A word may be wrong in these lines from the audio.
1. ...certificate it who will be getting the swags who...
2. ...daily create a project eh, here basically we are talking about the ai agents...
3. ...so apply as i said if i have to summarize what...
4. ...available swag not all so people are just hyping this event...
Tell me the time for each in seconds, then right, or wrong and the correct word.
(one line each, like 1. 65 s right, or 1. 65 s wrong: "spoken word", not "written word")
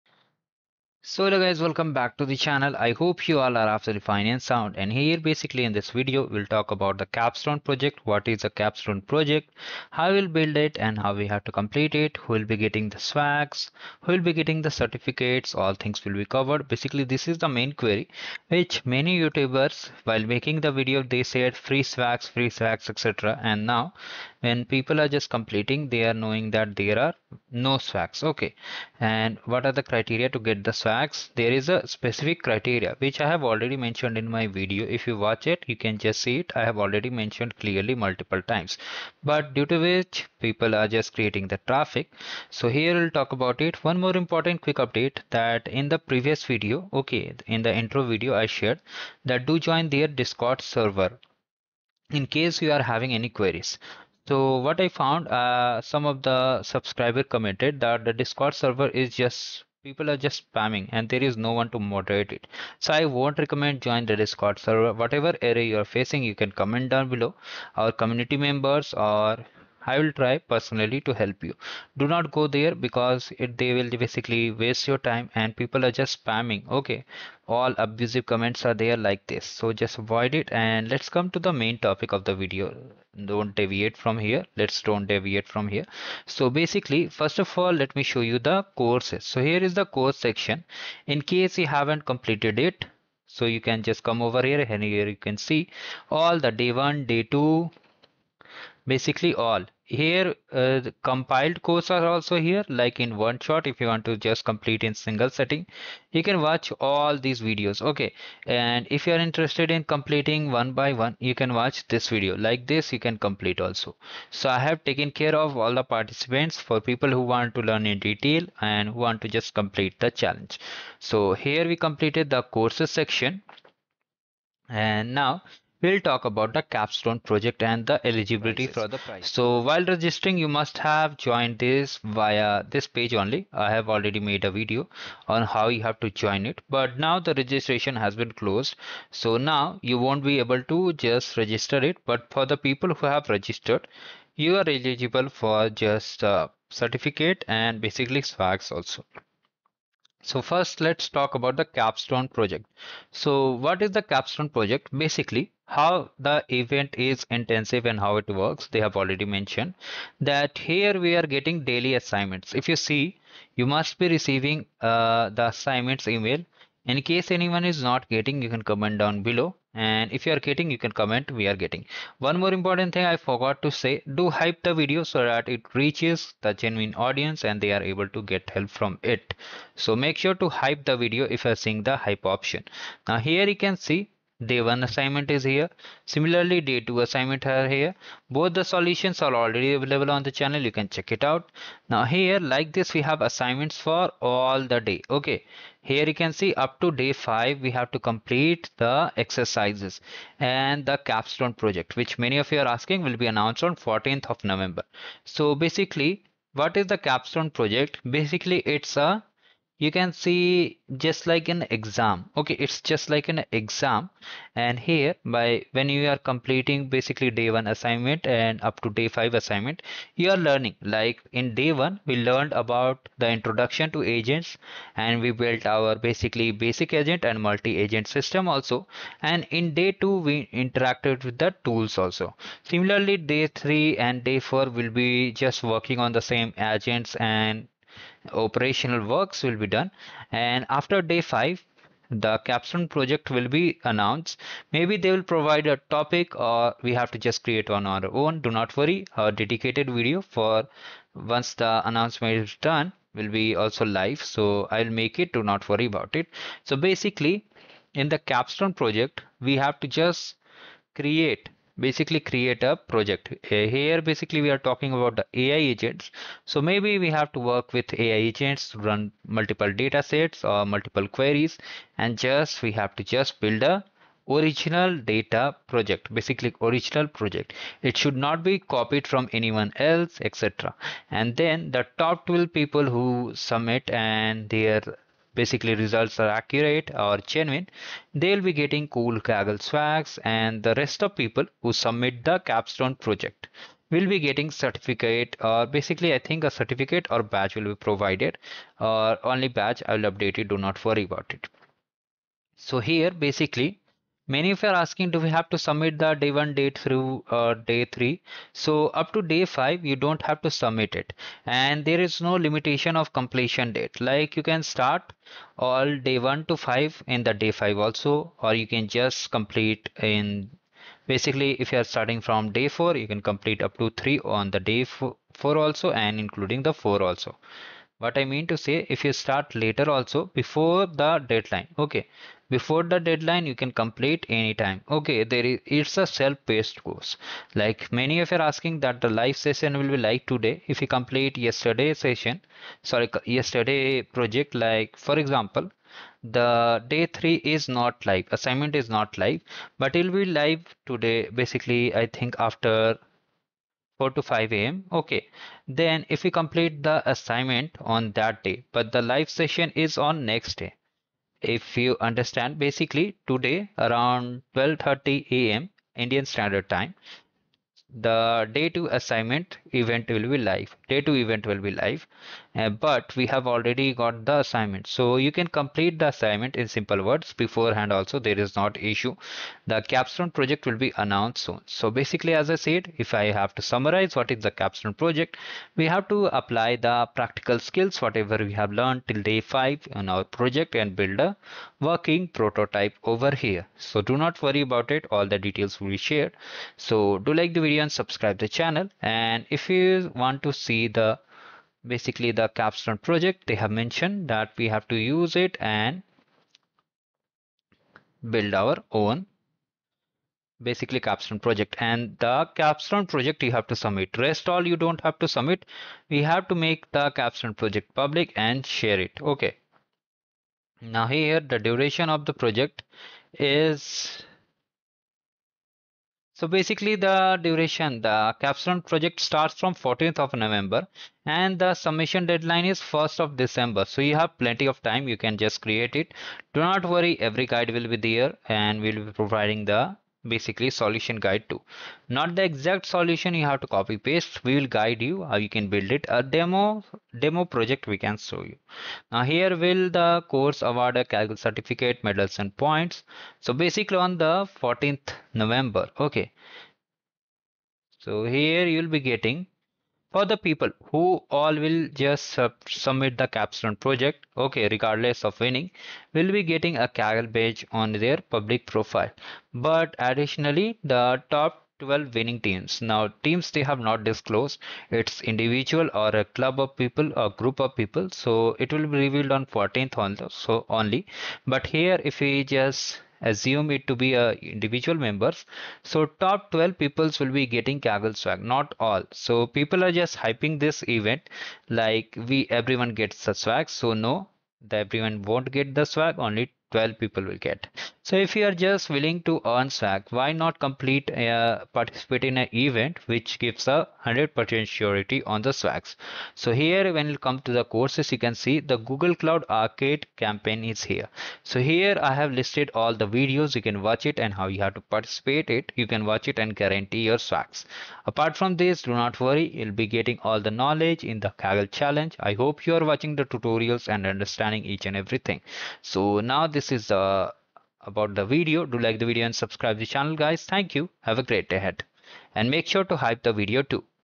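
1. 11 s wrong: "complete", not "certificate"
2. 261 s wrong: "basically", not "daily"
3. 381 s wrong: "basically", not "apply"
4. 487 s wrong: "kaggle", not "available".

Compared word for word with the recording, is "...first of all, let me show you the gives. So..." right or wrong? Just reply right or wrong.
wrong.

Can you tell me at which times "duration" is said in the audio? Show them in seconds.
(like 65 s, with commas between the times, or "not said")
421 s, 427 s.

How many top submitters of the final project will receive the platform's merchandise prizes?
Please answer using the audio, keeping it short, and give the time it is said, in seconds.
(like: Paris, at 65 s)
12, at 282 s.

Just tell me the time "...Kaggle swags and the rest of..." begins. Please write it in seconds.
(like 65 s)
289 s.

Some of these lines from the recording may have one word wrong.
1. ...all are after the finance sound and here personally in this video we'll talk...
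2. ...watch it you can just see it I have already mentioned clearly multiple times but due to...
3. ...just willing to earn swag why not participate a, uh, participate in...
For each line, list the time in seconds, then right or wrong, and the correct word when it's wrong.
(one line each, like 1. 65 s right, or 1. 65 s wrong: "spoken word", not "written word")
1. 3 s wrong: "basically", not "personally"
2. 35 s right
3. 498 s wrong: "complete", not "participate".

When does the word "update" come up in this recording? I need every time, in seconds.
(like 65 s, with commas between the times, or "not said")
44 s, 300 s.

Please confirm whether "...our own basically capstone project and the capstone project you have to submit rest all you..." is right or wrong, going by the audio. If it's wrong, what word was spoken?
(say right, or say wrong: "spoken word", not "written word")
right.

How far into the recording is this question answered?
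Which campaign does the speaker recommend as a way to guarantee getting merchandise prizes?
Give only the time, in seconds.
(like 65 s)
508 s.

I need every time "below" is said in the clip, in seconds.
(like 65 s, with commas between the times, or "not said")
67 s, 169 s.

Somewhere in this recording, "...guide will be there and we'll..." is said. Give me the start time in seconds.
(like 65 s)
437 s.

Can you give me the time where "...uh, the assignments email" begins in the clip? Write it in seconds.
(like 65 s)
164 s.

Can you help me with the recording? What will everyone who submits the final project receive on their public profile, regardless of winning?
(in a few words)
a badge.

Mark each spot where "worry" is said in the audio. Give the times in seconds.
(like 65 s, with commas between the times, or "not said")
248 s, 255 s, 300 s, 394 s, 436 s, 519 s.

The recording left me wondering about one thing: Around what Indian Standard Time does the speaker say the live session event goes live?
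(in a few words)
12:30 a.m.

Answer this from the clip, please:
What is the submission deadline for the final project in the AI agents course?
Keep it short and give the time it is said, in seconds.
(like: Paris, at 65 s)
1st of December, at 432 s.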